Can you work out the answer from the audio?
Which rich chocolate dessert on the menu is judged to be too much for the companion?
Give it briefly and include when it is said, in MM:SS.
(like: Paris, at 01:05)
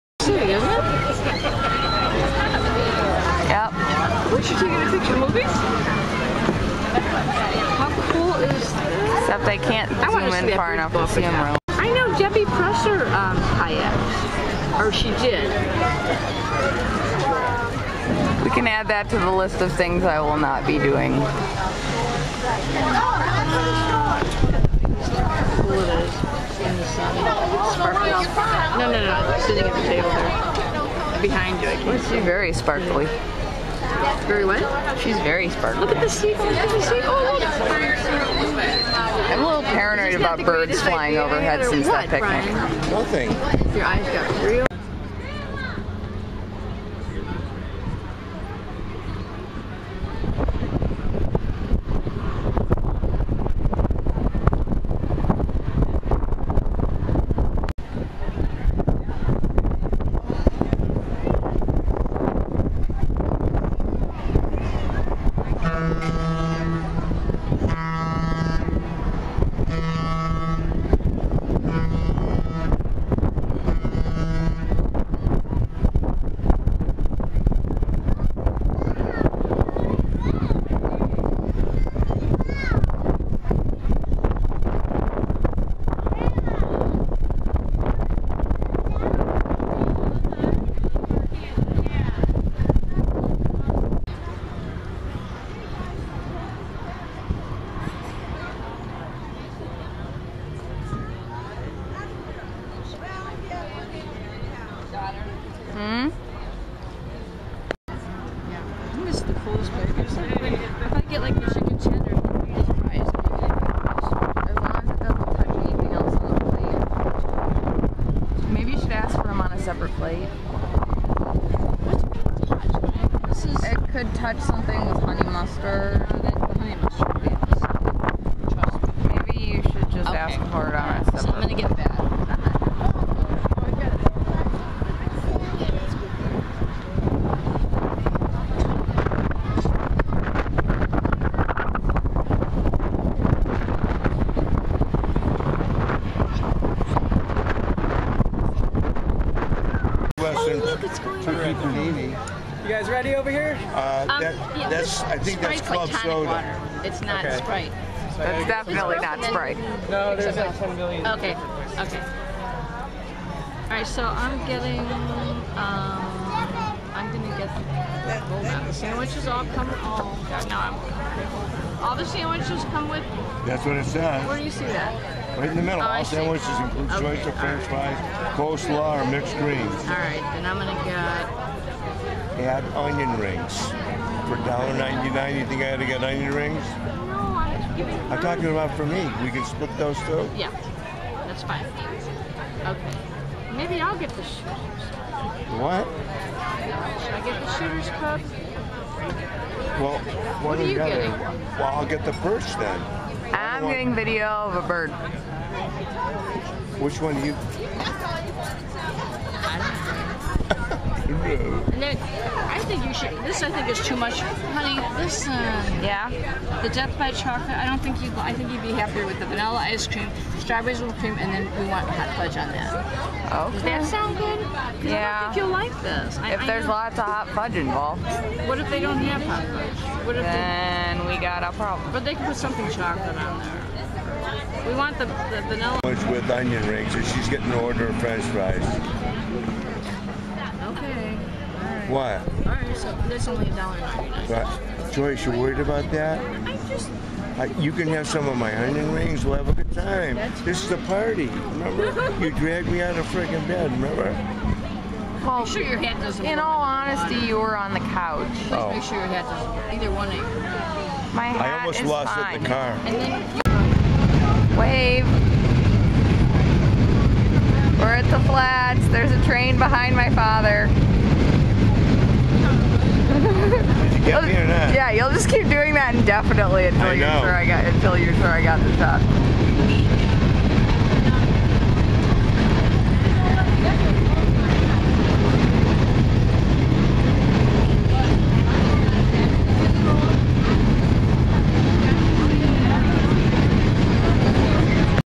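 Death by chocolate, at 03:36.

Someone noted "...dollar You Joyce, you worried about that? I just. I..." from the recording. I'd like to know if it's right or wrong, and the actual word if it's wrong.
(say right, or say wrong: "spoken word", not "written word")
wrong: "But", not "You".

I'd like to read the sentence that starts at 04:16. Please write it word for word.
In all honesty, you were on the couch.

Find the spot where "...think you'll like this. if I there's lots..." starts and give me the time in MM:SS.
03:45.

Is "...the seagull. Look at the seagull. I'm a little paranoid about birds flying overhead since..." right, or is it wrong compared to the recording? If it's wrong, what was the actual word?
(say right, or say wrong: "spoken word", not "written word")
right.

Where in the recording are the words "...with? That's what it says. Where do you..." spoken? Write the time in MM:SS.
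02:52.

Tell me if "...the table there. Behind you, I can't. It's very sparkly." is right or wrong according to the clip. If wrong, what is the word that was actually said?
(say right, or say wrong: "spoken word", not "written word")
right.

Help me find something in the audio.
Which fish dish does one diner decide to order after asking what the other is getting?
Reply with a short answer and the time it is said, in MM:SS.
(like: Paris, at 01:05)
perch, at 03:22.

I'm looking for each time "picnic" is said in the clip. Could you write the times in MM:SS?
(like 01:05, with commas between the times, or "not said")
00:42.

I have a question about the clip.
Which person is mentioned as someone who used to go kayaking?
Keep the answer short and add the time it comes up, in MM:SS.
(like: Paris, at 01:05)
Debbie Presser, at 00:12.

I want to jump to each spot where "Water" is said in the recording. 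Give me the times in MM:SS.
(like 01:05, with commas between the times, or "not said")
02:36.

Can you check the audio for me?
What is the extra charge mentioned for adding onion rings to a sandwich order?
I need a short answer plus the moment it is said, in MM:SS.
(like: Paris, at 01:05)
$1.99, at 03:04.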